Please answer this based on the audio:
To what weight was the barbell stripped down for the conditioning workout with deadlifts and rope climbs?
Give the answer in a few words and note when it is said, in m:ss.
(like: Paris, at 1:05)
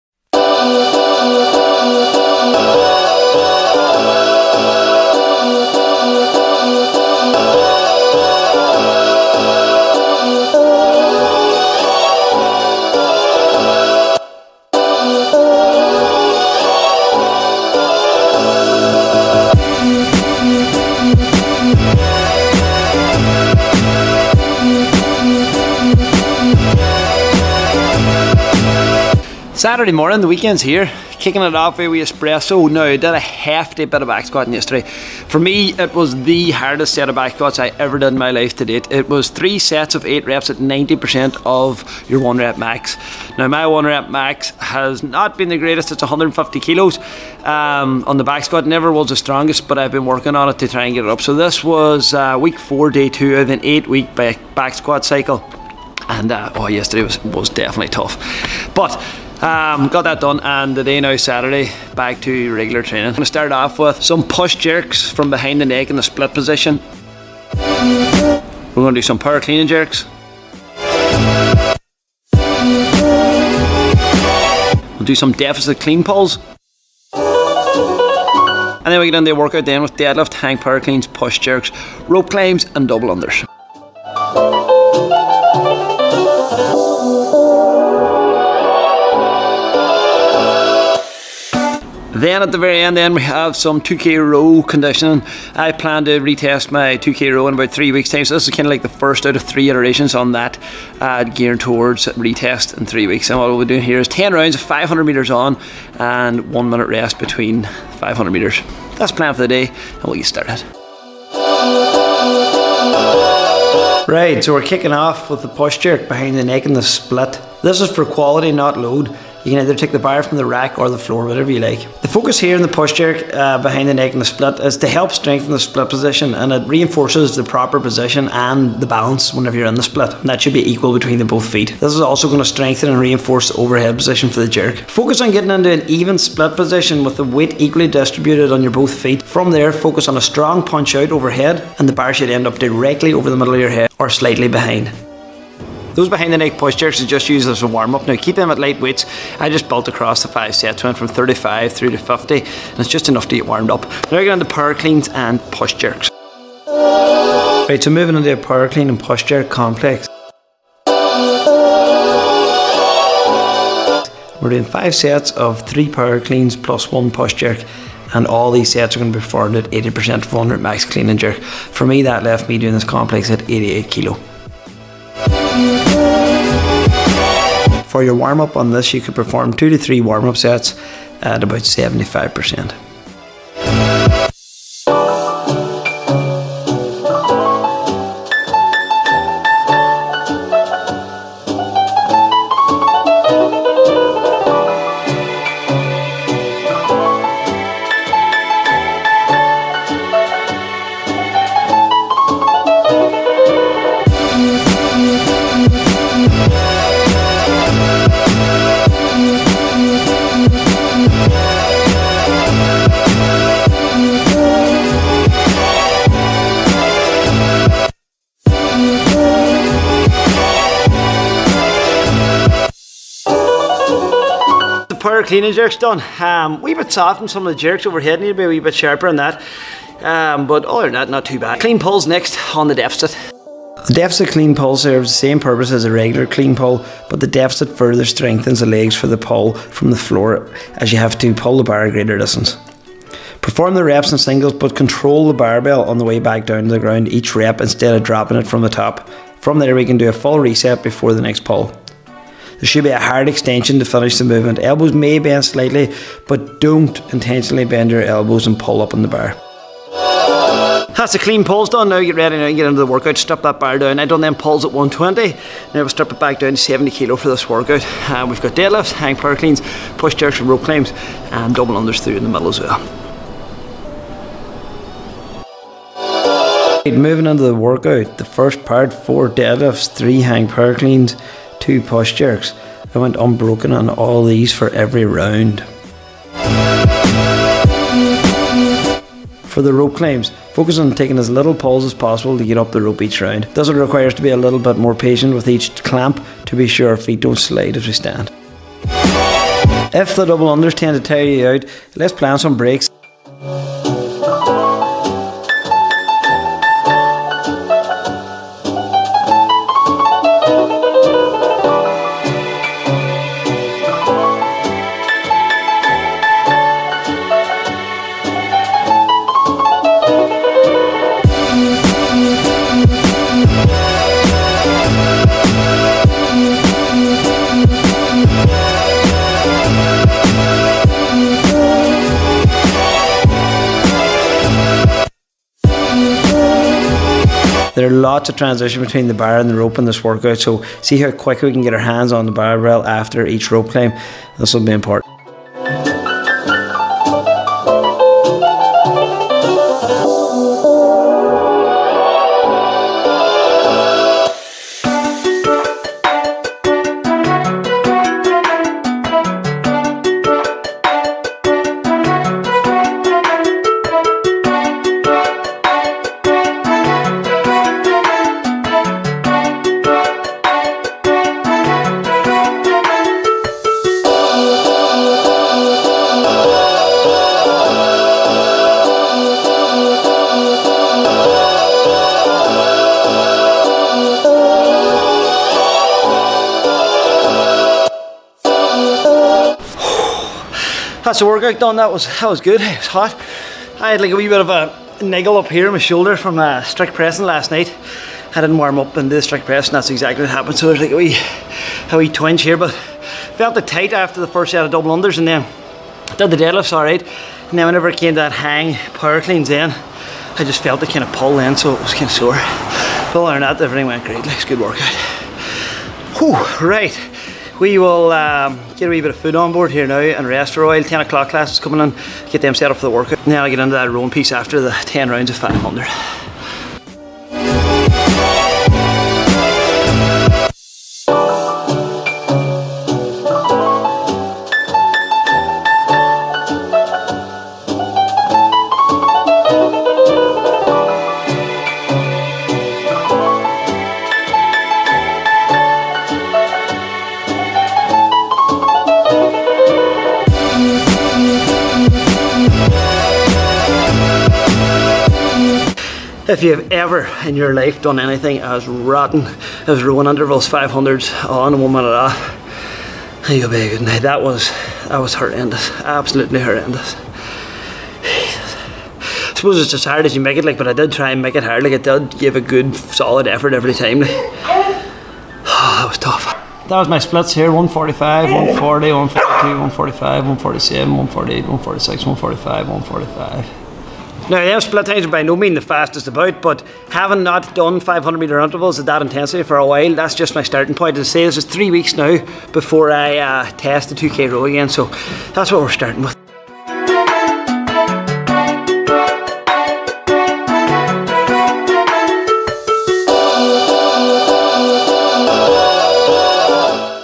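70 kilo, at 4:26.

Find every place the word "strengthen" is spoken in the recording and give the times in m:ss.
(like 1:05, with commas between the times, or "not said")
2:05, 2:12, 3:58.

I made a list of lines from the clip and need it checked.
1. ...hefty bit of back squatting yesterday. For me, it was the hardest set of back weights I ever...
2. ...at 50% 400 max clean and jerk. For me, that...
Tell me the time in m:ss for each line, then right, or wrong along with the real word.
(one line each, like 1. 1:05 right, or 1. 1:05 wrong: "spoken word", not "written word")
1. 0:33 wrong: "squats", not "weights"
2. 2:49 wrong: "80", not "50".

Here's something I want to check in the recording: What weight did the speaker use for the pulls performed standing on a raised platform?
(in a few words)
120.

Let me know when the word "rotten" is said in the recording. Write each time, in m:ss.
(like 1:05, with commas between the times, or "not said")
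7:38.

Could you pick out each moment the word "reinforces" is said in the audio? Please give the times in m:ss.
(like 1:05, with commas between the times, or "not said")
2:06, 2:12.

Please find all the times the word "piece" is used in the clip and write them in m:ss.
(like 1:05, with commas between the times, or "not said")
7:04.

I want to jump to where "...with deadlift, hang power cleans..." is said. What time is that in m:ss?
1:19.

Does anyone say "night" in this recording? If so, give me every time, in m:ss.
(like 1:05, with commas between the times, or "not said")
6:37, 7:43.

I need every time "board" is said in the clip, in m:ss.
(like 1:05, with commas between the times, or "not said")
6:59.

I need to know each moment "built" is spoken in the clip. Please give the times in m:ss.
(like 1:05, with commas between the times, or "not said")
2:29.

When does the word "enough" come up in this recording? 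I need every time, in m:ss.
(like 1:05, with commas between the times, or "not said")
2:33.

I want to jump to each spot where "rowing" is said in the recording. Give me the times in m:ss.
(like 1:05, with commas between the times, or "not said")
7:03, 7:39.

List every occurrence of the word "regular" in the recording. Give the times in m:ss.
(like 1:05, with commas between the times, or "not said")
1:02, 3:55.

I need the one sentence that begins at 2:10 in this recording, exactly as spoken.
And that should be equal between the both feet.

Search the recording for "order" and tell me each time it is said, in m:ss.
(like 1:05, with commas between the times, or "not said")
not said.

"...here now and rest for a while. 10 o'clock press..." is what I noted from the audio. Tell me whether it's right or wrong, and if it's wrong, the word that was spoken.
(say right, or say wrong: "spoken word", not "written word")
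wrong: "class", not "press".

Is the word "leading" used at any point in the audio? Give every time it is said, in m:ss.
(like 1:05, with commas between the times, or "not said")
not said.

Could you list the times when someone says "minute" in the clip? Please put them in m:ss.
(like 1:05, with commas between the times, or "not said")
1:46, 7:41.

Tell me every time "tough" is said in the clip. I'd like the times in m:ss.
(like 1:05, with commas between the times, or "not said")
0:57, 7:55.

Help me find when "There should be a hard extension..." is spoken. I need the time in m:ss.
4:12.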